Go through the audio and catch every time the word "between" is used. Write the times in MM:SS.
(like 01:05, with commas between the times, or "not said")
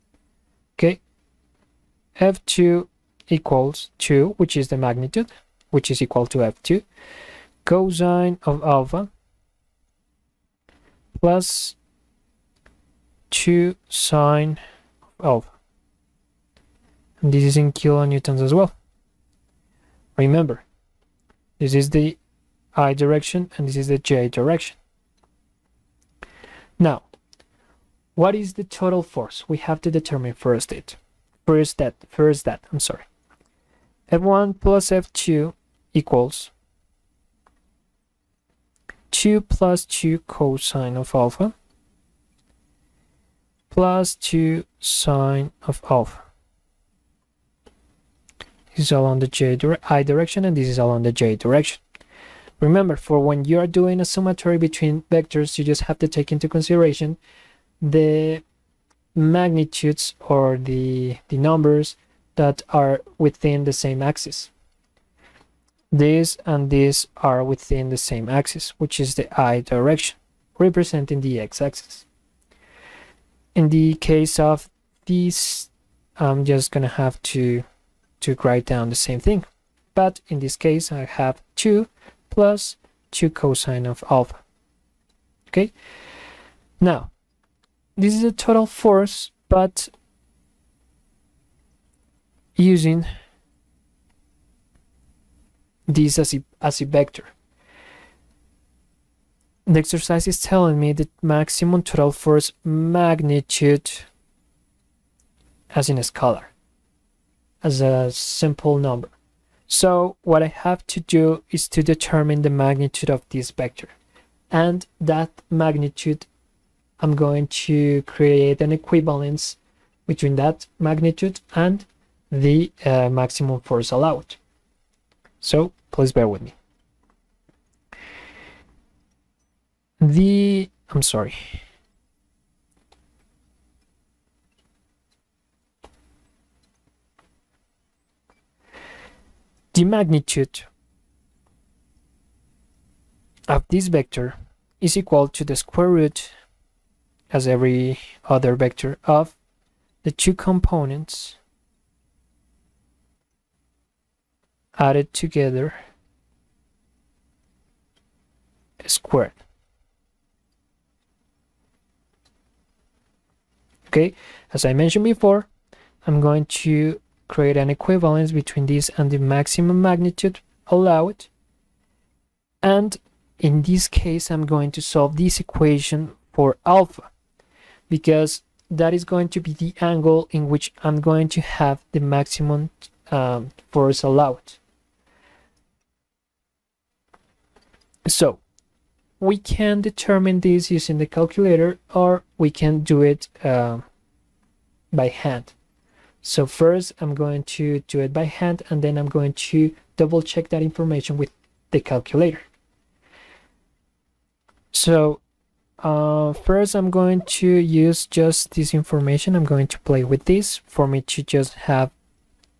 00:54, 02:00, 02:48.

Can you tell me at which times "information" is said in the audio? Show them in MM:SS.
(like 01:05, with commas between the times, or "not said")
03:20, 03:28.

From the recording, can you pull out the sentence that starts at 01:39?
The exercise is telling me the maximum total force magnitude as in a scalar as a simple number.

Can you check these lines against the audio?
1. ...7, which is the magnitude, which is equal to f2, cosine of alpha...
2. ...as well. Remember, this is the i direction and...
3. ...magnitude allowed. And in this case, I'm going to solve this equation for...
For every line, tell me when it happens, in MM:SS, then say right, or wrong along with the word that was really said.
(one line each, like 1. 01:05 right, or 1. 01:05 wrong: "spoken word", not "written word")
1. 00:03 wrong: "2", not "7"
2. 00:18 right
3. 02:49 right.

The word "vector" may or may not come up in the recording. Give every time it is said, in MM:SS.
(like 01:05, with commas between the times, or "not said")
00:55, 01:36, 01:53, 02:23, 02:28.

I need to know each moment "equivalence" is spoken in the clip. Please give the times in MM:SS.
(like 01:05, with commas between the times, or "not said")
01:58, 02:47.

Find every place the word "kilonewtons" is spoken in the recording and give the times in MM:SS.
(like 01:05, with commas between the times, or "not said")
00:17.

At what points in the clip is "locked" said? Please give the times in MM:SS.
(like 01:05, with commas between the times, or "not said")
not said.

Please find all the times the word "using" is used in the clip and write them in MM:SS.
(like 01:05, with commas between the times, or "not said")
01:32, 03:10.